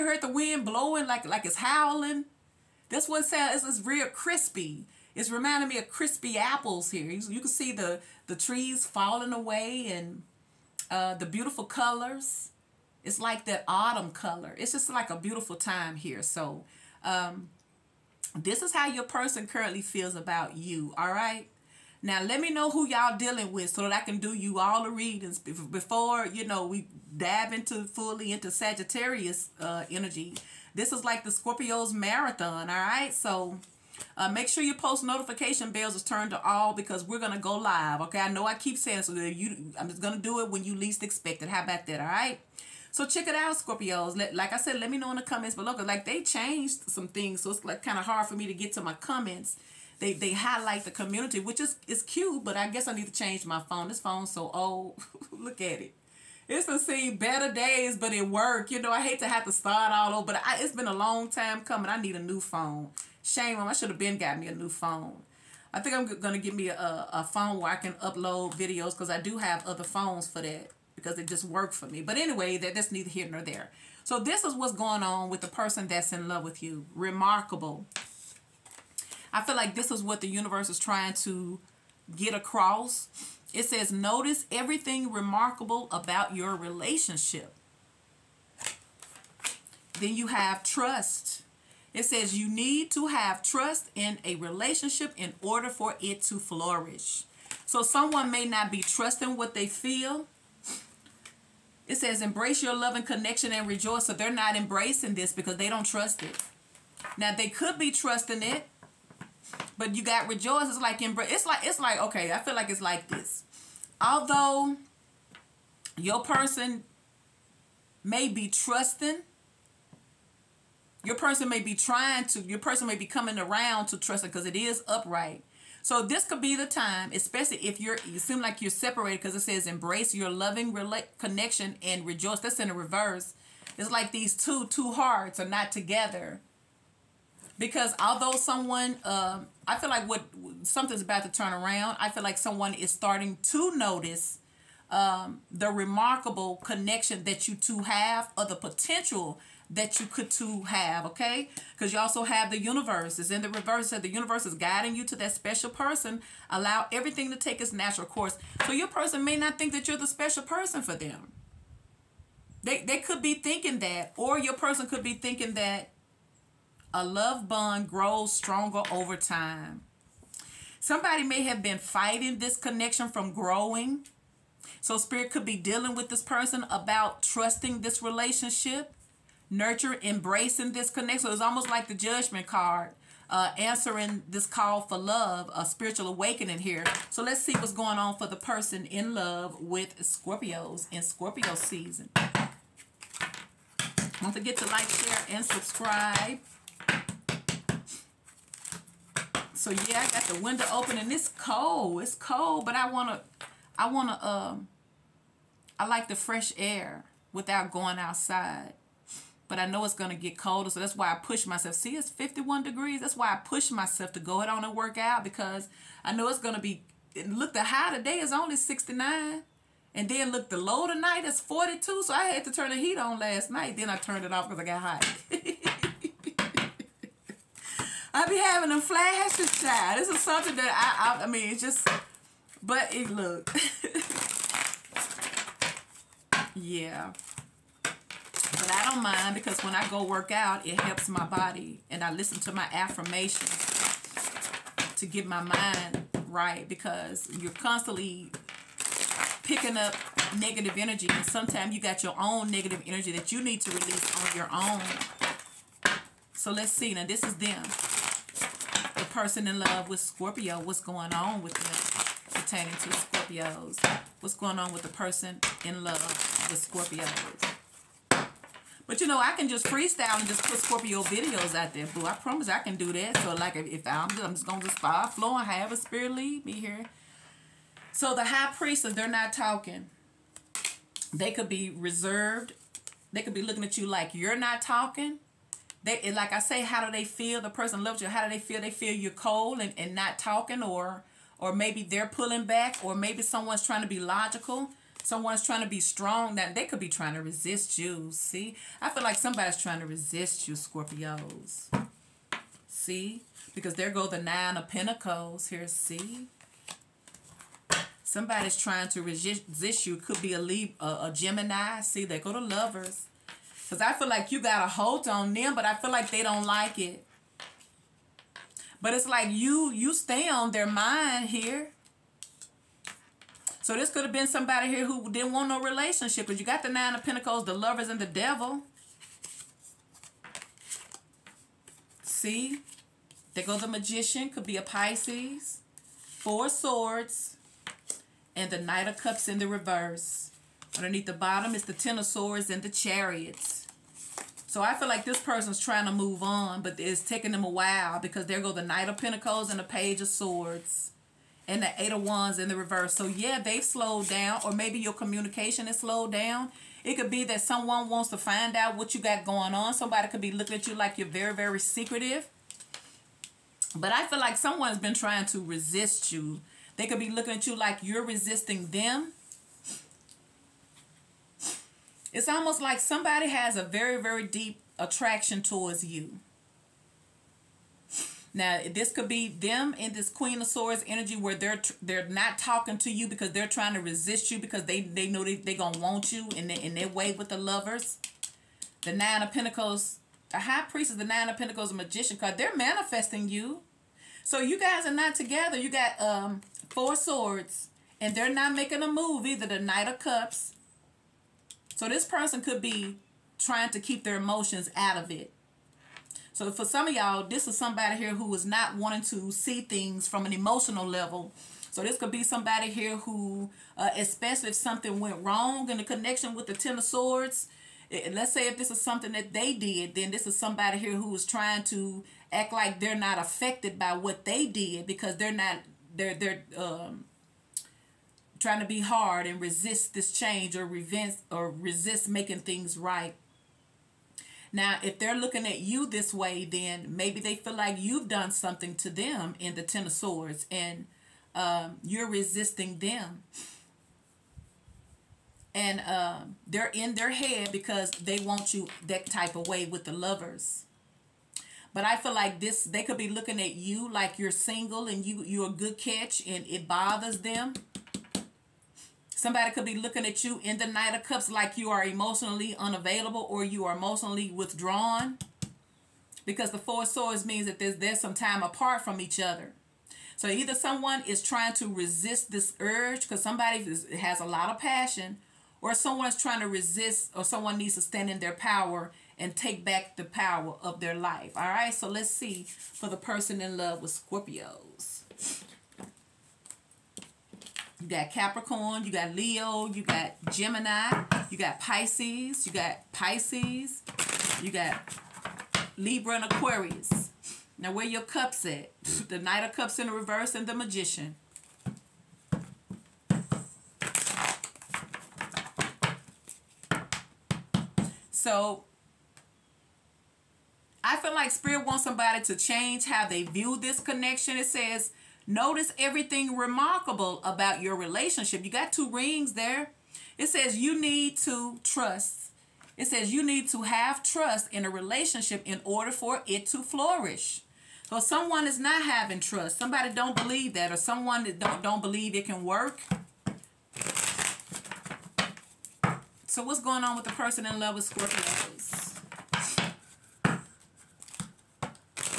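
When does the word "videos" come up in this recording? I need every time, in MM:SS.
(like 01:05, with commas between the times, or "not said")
01:08, 04:31.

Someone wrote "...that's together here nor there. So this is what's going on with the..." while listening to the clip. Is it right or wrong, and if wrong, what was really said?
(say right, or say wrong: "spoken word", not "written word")
wrong: "neither", not "together".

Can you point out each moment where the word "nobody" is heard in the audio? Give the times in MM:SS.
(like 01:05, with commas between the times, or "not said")
not said.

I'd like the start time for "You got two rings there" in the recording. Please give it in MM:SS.
08:38.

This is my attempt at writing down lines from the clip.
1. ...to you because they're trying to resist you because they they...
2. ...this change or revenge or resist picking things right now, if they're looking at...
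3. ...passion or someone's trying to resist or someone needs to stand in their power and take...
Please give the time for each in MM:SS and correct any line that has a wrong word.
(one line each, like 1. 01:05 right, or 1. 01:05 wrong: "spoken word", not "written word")
1. 06:22 right
2. 07:09 wrong: "making", not "picking"
3. 07:54 right.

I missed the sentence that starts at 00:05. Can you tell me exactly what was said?
It's reminding me of crispy apples here.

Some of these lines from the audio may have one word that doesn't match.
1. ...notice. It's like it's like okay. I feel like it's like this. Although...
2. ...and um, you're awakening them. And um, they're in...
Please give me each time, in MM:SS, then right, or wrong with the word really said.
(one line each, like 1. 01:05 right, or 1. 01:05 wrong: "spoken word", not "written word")
1. 01:51 wrong: "embrace", not "notice"
2. 07:20 wrong: "resisting", not "awakening".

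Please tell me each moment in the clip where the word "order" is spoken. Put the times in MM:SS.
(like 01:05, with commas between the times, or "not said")
01:35, 08:45.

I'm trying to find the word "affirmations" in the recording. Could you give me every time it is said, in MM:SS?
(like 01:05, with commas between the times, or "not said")
04:02.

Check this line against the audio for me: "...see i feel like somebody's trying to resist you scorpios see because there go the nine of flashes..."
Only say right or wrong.
wrong.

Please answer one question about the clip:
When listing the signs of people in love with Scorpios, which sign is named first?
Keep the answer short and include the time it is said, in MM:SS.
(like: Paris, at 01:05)
Capricorn, at 08:08.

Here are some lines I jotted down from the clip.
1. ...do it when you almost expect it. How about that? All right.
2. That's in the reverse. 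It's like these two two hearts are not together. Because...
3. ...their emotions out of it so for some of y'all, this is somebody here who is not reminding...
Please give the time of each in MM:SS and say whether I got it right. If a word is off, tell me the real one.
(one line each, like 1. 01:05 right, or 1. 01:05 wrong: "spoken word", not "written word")
1. 00:40 wrong: "least", not "almost"
2. 02:12 right
3. 06:44 wrong: "wanting", not "reminding".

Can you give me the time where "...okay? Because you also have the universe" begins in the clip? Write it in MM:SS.
02:31.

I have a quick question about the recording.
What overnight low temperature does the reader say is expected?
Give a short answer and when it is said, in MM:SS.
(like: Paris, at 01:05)
42, at 03:41.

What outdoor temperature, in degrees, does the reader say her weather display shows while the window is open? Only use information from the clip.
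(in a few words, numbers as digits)
51.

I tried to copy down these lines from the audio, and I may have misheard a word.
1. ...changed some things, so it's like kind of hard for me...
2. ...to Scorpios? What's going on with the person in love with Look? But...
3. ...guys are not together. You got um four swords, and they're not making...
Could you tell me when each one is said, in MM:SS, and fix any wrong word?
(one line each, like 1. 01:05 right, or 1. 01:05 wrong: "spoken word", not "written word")
1. 00:46 right
2. 04:22 wrong: "Scorpios", not "Look"
3. 06:34 right.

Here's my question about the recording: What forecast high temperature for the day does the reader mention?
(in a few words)
69.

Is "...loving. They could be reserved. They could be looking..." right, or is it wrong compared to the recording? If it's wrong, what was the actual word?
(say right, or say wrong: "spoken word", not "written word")
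wrong: "talking", not "loving".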